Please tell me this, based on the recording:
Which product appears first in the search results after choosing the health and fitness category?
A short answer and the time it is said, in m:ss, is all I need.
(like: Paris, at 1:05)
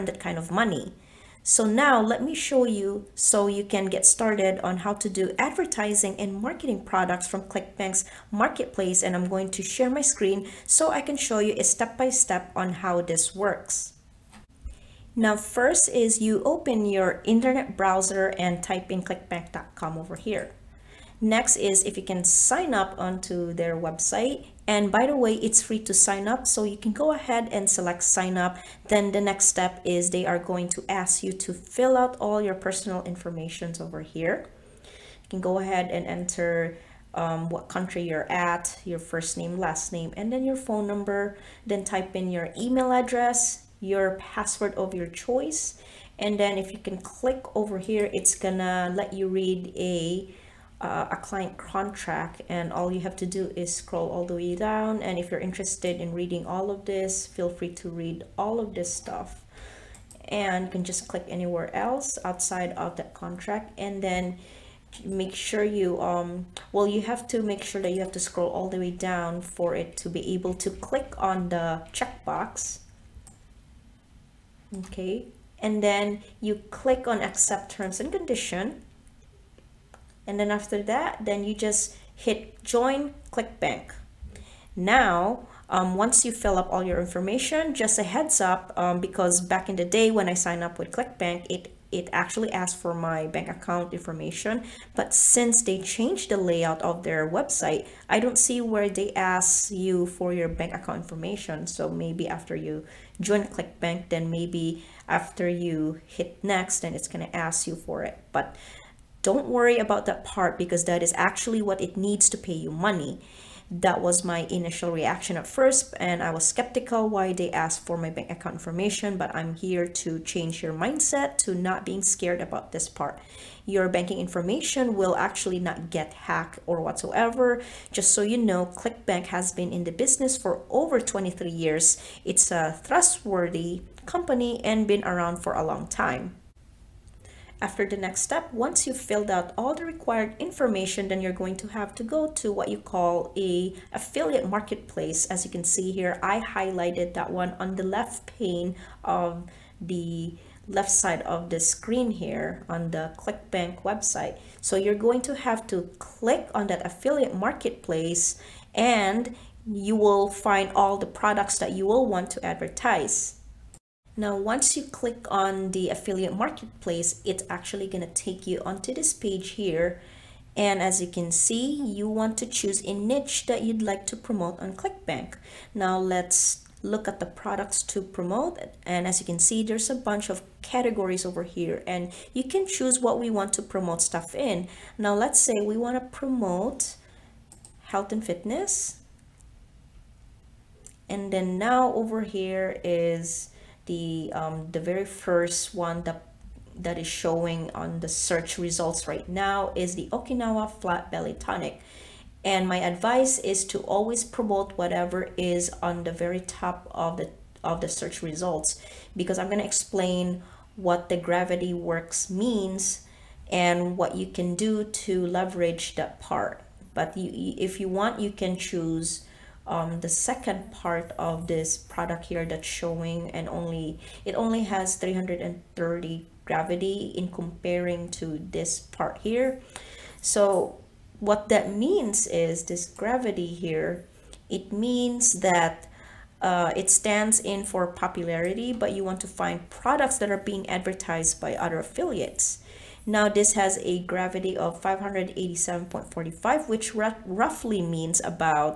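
Okinawa Flat Belly Tonic, at 3:20.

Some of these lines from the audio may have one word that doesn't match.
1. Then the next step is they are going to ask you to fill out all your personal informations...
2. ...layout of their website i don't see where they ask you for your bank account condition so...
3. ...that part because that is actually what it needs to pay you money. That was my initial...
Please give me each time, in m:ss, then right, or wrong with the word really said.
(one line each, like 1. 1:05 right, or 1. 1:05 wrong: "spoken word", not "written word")
1. 0:28 right
2. 1:36 wrong: "information", not "condition"
3. 1:50 right.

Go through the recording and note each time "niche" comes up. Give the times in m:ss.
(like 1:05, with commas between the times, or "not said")
2:52.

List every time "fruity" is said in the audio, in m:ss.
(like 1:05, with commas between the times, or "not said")
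not said.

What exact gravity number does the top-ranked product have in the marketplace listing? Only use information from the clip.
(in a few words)
587.45.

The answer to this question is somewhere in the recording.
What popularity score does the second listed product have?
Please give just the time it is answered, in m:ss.
3:44.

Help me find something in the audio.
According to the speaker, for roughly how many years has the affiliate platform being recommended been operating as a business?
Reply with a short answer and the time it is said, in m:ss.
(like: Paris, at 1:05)
23 years, at 2:11.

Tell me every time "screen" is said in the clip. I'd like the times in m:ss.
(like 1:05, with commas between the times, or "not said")
0:10, 2:31.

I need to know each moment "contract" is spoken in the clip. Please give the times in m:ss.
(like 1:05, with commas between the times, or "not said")
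0:51, 1:03.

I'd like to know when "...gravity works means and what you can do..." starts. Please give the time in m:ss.
3:31.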